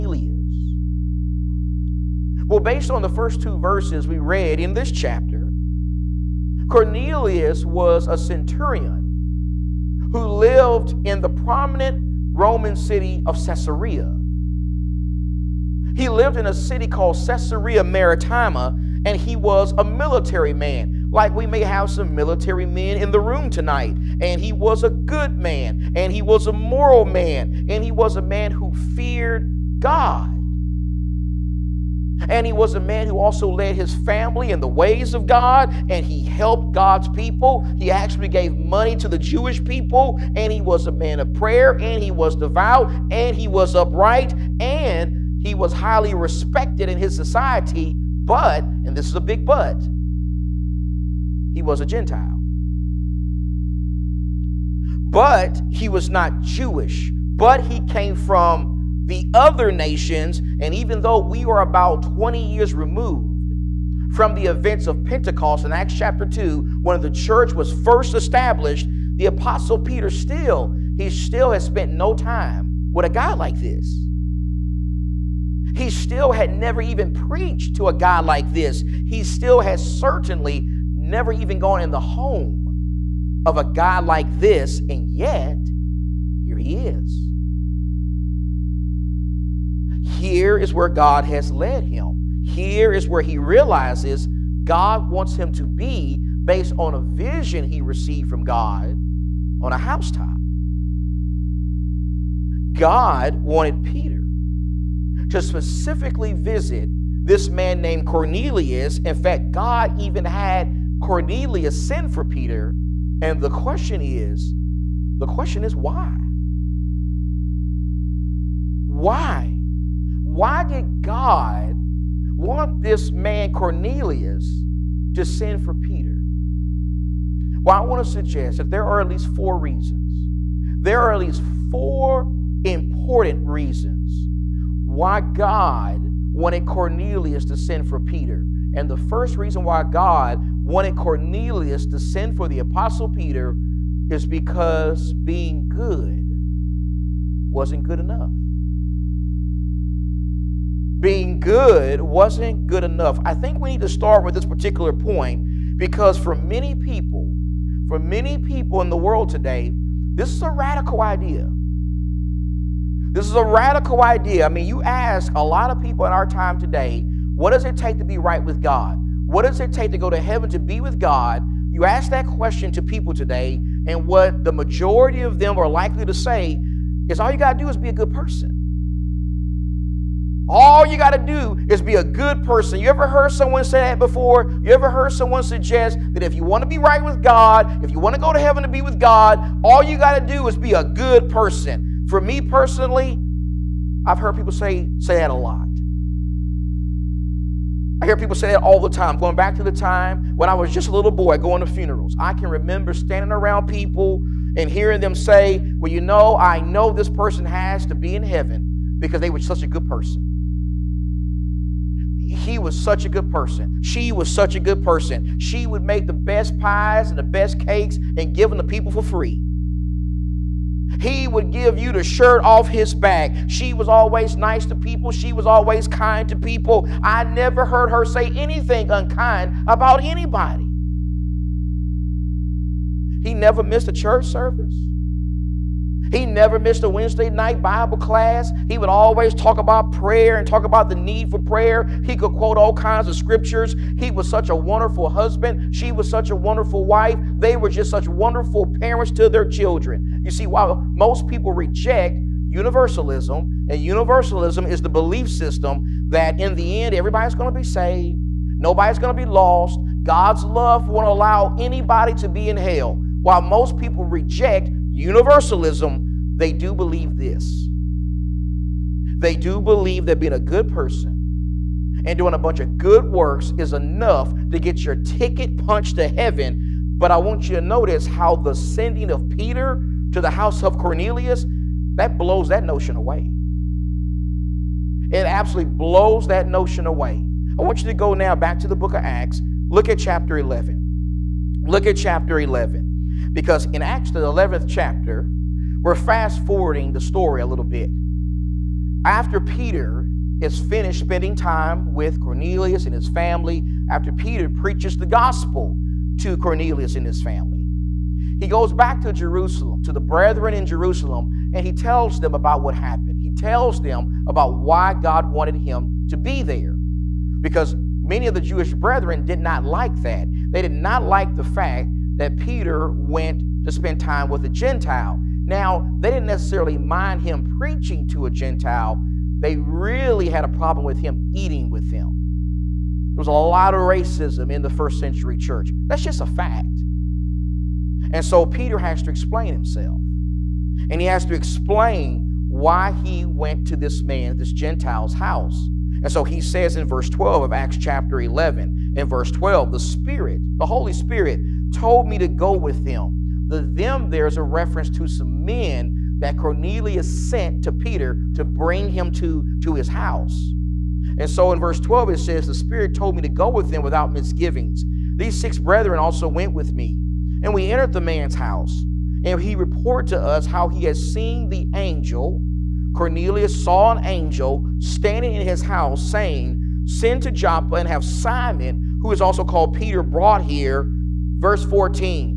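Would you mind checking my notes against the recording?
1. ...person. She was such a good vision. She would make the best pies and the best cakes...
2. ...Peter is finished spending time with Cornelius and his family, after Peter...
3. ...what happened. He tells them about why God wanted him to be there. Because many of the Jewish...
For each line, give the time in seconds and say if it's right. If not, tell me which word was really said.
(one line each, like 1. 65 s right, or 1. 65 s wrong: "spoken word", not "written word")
1. 213 s wrong: "person", not "vision"
2. 299 s right
3. 312 s right.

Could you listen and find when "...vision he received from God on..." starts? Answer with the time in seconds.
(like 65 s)
97 s.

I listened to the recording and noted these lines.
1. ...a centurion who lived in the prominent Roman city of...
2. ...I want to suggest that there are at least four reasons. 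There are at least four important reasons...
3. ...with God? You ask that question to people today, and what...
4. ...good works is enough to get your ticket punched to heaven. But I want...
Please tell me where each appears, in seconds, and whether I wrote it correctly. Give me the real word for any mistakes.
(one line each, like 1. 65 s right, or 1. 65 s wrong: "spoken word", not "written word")
1. 8 s right
2. 127 s right
3. 170 s right
4. 272 s right.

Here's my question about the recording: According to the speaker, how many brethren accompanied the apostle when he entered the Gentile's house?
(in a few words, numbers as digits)
6.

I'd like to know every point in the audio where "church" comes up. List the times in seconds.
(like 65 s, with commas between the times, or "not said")
67 s, 233 s, 335 s.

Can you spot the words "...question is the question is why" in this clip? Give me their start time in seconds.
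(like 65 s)
113 s.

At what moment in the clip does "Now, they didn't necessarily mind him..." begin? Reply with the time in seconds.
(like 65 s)
325 s.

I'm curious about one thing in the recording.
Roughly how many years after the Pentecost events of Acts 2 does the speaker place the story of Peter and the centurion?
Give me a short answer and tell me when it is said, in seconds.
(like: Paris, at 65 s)
20, at 62 s.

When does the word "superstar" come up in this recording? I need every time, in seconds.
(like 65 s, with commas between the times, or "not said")
not said.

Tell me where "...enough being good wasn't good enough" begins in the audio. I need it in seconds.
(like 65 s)
147 s.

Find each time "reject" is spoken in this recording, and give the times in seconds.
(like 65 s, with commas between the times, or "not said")
251 s, 264 s.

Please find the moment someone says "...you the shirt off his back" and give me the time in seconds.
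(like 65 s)
221 s.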